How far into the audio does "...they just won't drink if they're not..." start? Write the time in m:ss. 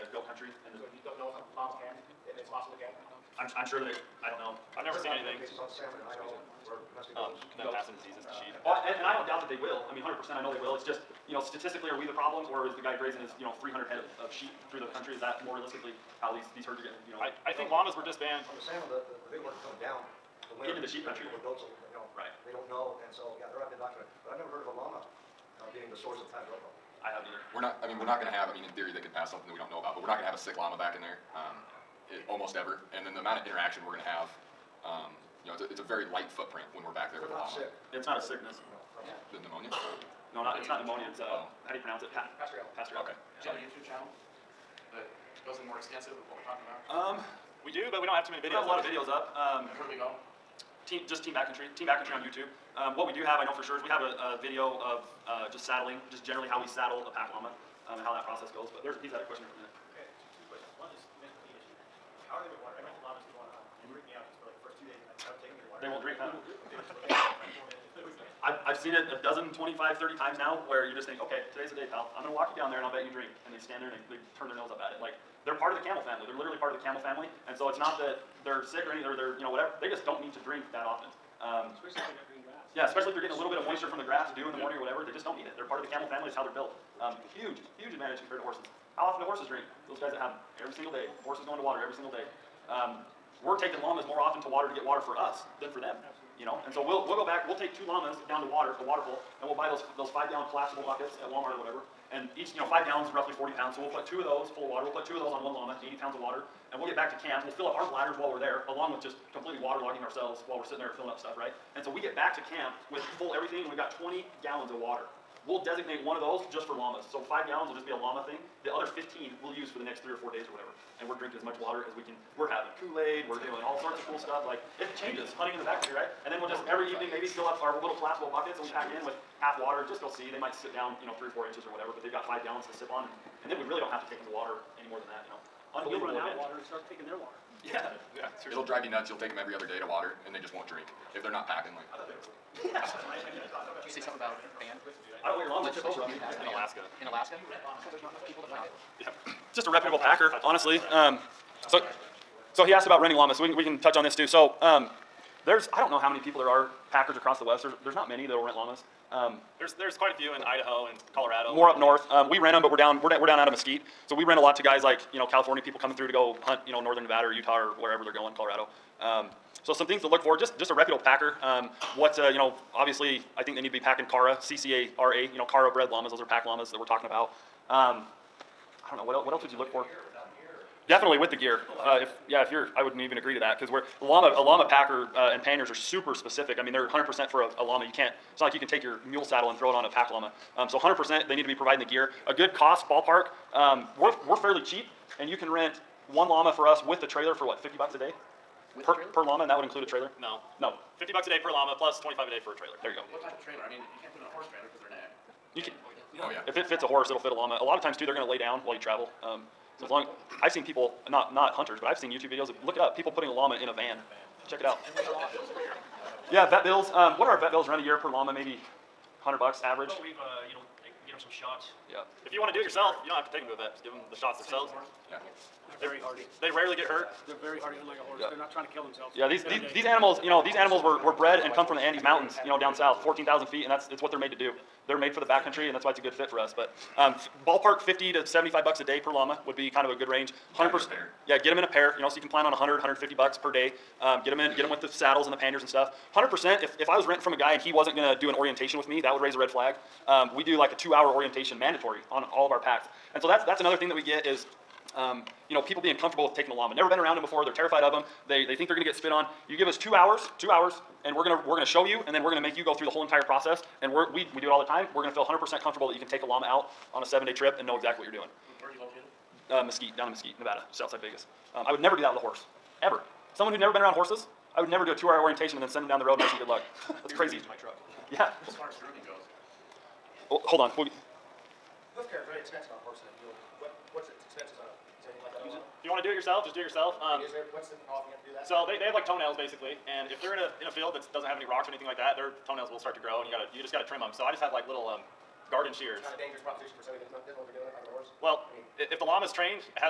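2:20.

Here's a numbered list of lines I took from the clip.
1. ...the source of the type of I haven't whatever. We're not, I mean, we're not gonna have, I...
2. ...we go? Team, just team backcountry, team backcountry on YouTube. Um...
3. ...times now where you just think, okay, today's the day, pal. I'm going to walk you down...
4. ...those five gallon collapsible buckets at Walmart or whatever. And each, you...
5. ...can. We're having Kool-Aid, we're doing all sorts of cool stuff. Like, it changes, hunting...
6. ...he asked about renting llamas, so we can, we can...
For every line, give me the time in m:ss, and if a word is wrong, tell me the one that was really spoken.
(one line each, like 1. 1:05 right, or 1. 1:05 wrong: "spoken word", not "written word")
1. 0:25 wrong: "either", not "whatever"
2. 0:49 right
3. 1:10 right
4. 1:39 right
5. 2:02 right
6. 2:32 right.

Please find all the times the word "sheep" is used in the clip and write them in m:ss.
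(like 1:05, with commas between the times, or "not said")
0:14, 0:20.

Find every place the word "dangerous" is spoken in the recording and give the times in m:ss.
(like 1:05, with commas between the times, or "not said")
4:56.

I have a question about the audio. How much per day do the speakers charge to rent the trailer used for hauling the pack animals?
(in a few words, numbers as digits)
$25.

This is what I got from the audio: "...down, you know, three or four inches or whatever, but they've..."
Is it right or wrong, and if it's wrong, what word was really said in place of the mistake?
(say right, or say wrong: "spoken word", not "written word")
right.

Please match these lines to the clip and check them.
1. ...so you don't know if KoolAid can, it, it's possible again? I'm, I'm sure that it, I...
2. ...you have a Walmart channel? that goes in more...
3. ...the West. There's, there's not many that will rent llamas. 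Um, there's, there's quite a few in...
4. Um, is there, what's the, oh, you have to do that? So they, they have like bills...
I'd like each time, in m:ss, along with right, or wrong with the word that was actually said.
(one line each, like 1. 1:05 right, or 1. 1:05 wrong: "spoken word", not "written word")
1. 0:00 wrong: "Rob", not "KoolAid"
2. 0:43 wrong: "YouTube", not "Walmart"
3. 2:37 right
4. 4:46 wrong: "toenails", not "bills".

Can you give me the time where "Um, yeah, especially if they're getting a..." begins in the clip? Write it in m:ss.
1:21.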